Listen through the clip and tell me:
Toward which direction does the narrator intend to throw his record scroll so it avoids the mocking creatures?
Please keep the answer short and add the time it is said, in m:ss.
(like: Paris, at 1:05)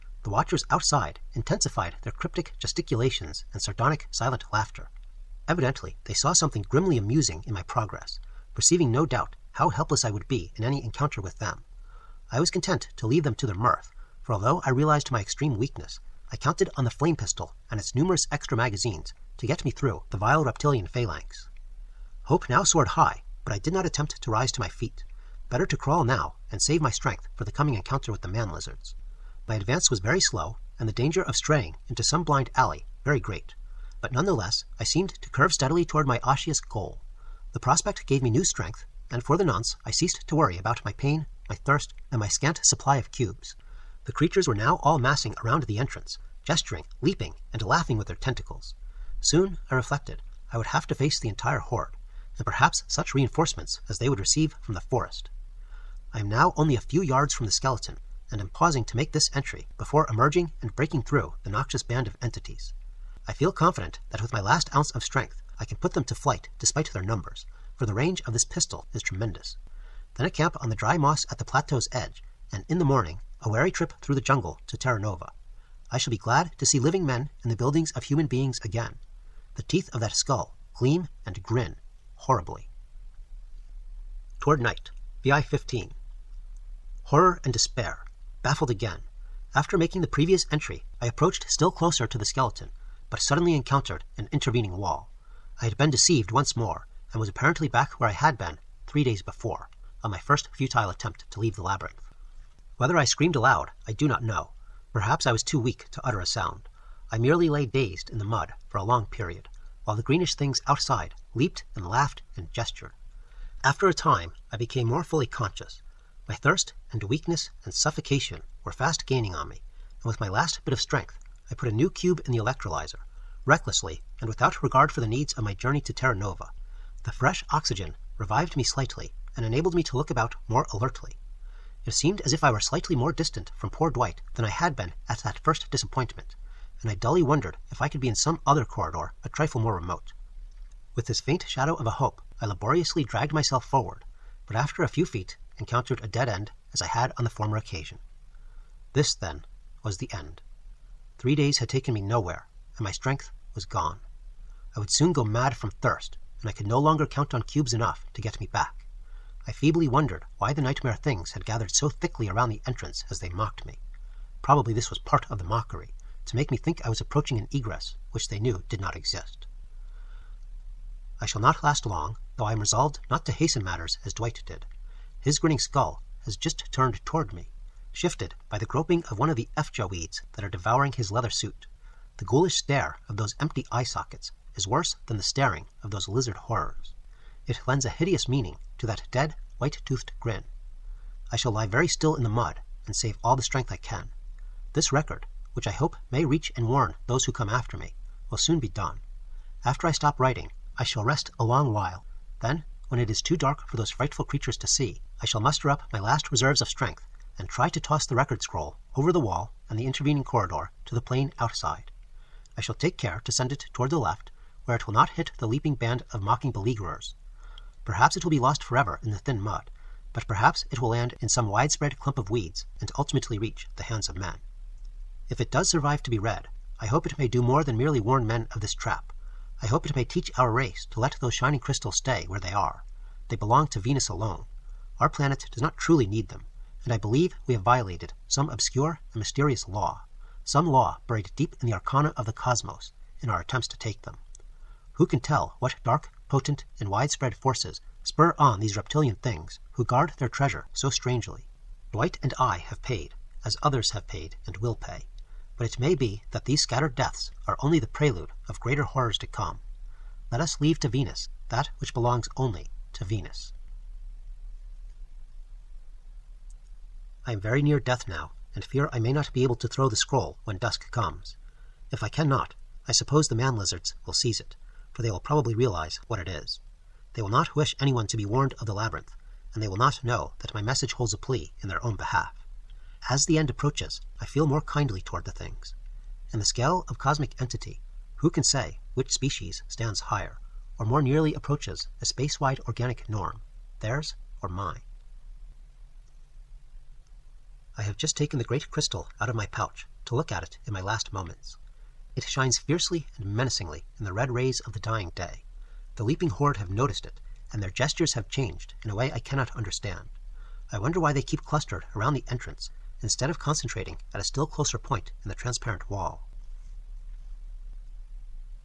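left, at 3:33.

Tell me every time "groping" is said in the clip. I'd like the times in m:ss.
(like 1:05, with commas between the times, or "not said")
2:58.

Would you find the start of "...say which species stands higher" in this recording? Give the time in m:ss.
4:48.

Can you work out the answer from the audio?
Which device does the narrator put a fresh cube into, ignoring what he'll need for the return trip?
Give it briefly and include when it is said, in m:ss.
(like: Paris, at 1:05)
electrolyzer, at 2:02.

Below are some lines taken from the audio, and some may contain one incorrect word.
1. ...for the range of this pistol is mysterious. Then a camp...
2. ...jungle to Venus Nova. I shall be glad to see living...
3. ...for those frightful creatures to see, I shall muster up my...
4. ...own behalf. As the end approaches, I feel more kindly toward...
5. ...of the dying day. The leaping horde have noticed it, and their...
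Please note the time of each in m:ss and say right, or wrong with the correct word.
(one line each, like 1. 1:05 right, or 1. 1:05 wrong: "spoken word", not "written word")
1. 1:07 wrong: "tremendous", not "mysterious"
2. 1:14 wrong: "Terra", not "Venus"
3. 3:23 right
4. 4:41 right
5. 5:04 right.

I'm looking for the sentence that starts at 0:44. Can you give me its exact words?
The creatures were now all massing around the entrance, gesturing, leaping, and laughing with their tentacles.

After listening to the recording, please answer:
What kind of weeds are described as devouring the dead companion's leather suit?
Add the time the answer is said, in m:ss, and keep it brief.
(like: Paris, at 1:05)
efjeh weeds, at 2:59.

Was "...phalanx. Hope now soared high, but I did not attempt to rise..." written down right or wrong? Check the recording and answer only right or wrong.
right.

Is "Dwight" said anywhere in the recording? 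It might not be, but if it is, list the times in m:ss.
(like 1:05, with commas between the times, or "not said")
2:13, 2:54, 4:11.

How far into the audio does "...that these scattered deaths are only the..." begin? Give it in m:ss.
4:16.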